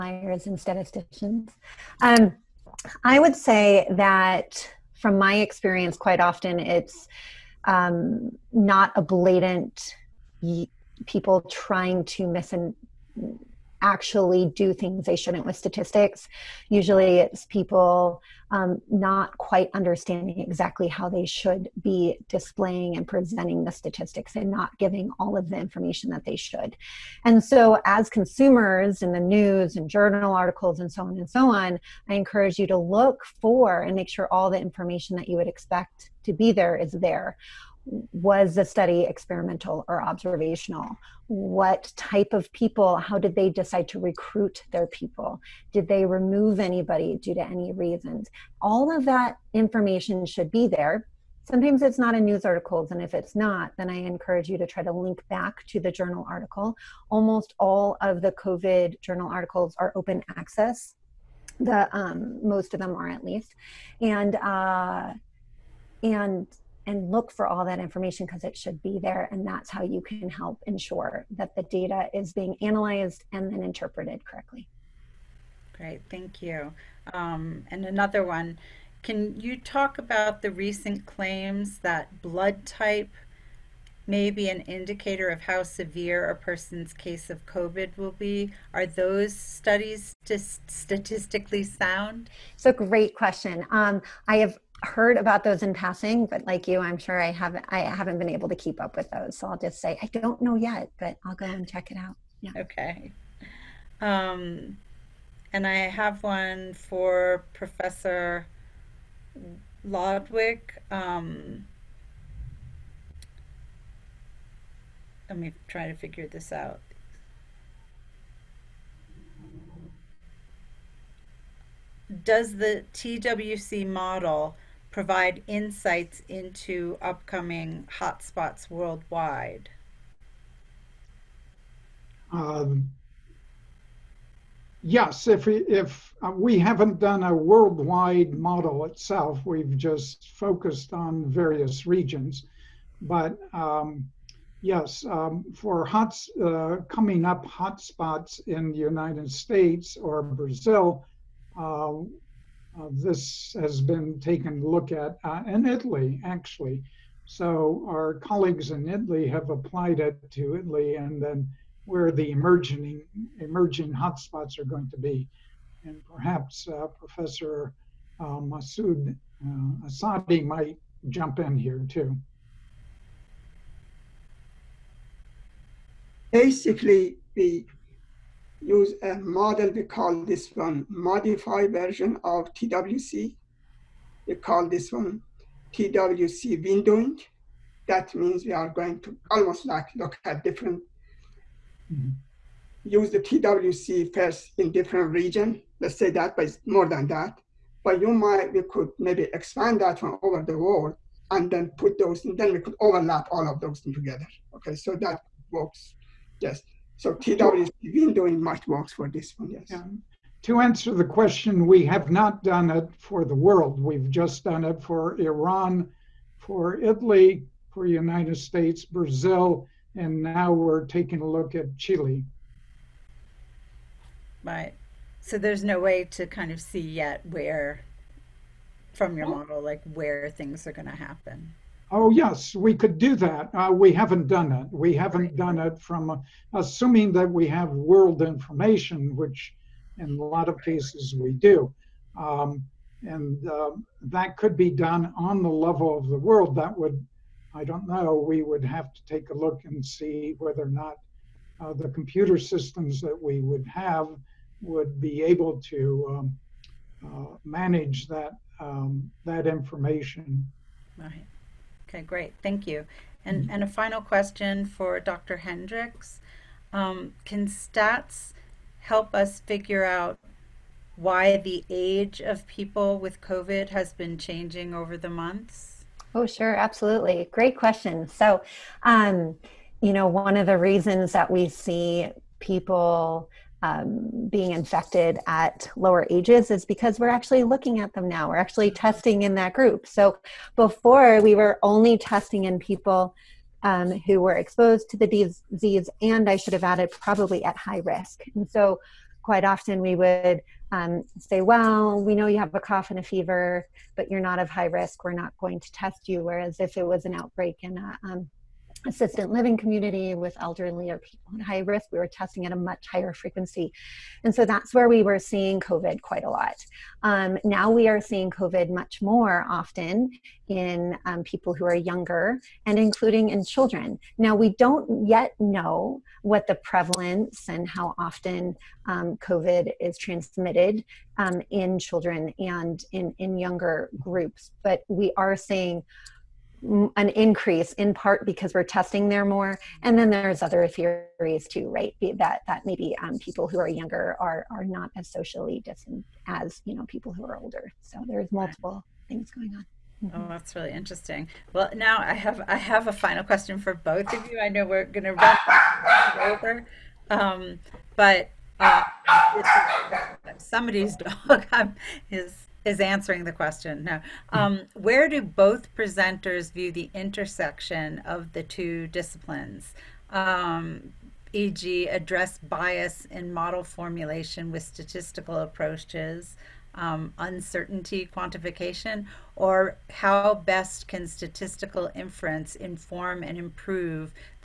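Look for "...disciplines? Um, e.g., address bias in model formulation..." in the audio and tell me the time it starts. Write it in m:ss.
6:08.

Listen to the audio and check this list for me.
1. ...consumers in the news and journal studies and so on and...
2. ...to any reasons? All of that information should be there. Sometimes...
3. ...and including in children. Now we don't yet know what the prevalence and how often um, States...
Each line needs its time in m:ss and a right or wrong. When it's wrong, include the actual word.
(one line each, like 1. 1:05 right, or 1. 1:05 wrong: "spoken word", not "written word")
1. 0:28 wrong: "articles", not "studies"
2. 0:47 right
3. 5:22 wrong: "COVID", not "States".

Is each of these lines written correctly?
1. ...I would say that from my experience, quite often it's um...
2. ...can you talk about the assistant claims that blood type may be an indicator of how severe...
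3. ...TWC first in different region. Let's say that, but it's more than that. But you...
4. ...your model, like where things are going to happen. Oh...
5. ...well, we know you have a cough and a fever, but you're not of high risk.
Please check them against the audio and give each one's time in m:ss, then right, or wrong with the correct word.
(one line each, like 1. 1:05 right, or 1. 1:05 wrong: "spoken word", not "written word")
1. 0:03 right
2. 1:19 wrong: "recent", not "assistant"
3. 3:13 right
4. 3:49 right
5. 5:01 right.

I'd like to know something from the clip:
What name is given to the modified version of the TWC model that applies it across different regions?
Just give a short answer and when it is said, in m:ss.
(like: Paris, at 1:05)
TWC windowing, at 3:05.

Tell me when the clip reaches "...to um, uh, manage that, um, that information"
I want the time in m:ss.
4:15.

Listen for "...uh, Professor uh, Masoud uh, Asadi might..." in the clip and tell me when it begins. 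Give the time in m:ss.
2:46.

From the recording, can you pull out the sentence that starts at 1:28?
Are those studies just statistically sound?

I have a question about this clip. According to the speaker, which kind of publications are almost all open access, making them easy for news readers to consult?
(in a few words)
COVID journal articles.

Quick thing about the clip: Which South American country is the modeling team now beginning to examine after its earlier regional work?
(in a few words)
Chile.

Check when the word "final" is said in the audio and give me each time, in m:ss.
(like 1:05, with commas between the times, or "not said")
4:23, 5:52.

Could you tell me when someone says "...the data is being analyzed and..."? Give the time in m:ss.
1:11.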